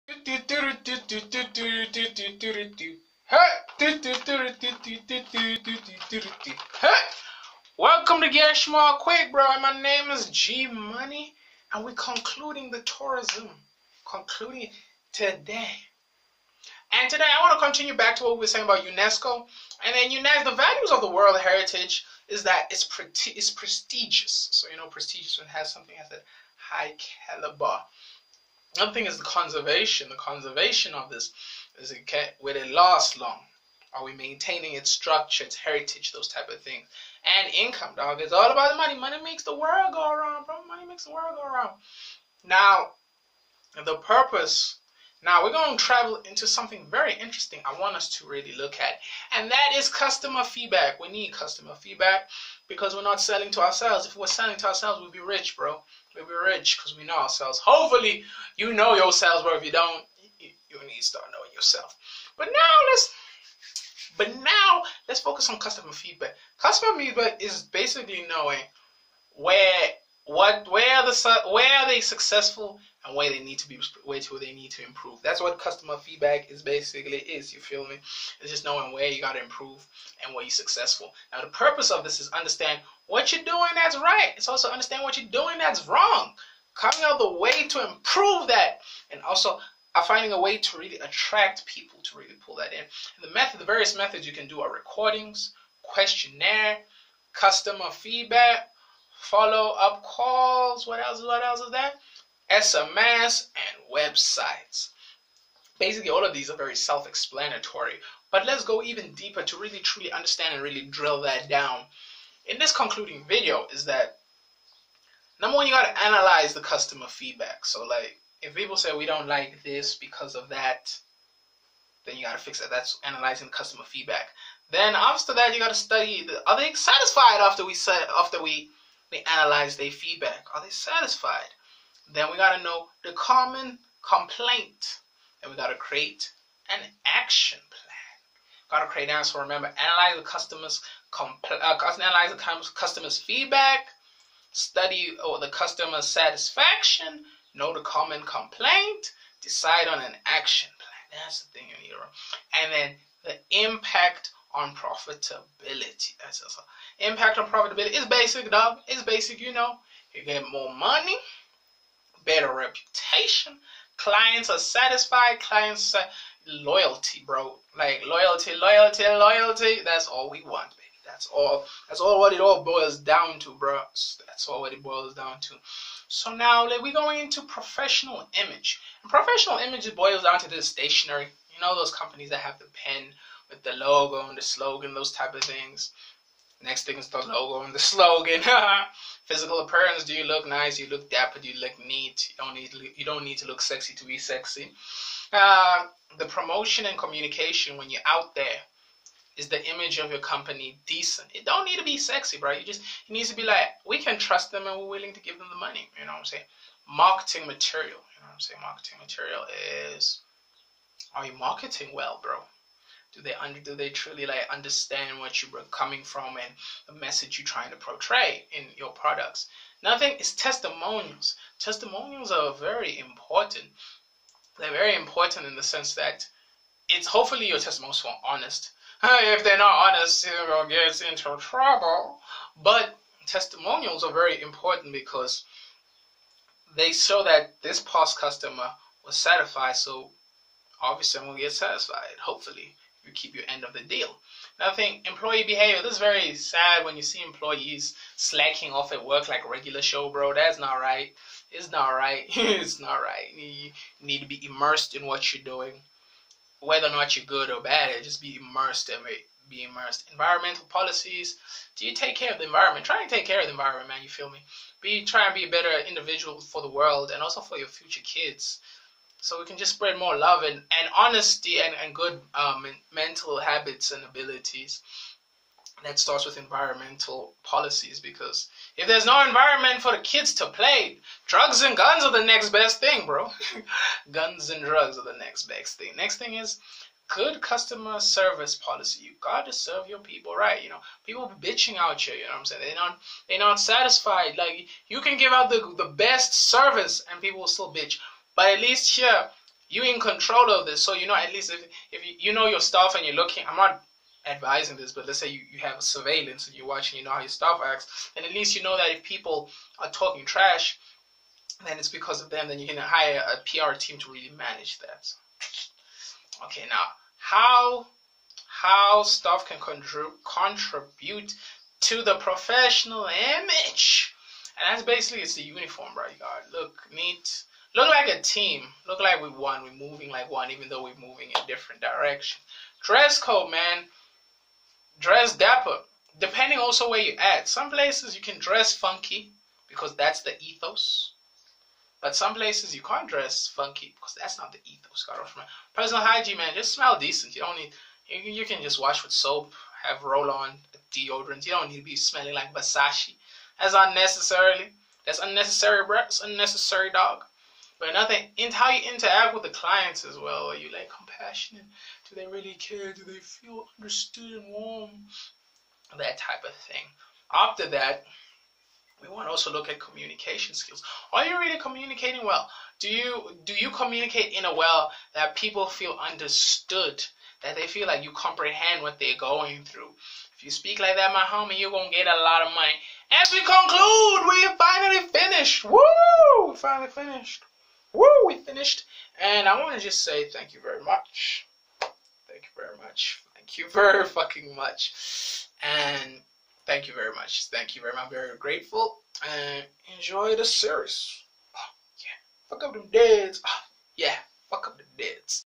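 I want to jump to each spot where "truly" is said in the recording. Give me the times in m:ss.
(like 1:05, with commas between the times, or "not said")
1:49, 3:33.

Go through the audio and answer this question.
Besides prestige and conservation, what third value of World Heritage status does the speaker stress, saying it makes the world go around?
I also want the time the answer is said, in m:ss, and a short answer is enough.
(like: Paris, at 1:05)
Income, at 0:37.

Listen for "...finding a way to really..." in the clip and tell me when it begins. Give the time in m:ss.
1:30.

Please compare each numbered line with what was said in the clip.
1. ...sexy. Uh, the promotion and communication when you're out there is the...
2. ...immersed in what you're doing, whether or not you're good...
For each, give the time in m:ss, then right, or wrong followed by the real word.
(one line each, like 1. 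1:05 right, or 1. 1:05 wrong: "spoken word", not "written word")
1. 3:14 right
2. 4:14 right.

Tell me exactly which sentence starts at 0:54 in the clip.
If we're selling to ourselves, we'd be rich, bro.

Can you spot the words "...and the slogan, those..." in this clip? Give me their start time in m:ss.
3:04.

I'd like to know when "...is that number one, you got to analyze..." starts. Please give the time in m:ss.
1:53.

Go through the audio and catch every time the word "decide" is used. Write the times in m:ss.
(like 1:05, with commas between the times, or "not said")
2:29.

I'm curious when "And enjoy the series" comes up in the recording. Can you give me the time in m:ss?
6:39.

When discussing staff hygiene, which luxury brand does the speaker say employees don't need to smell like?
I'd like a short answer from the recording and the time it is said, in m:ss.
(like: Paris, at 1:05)
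Versace, at 5:52.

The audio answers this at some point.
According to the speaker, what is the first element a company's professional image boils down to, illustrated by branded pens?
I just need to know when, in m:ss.
3:00.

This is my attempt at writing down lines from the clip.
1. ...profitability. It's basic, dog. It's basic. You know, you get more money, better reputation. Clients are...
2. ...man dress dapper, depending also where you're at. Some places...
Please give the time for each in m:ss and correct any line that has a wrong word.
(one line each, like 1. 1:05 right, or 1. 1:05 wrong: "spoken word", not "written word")
1. 2:37 right
2. 5:33 right.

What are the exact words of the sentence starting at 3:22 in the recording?
You just it needs to be like we can trust them and we're willing to give them the money.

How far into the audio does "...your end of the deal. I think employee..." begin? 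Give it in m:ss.
4:03.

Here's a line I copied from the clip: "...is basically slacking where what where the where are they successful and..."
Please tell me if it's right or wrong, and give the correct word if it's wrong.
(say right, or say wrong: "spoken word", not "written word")
wrong: "knowing", not "slacking".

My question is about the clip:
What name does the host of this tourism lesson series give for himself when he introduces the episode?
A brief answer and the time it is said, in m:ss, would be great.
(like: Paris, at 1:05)
G Money, at 0:10.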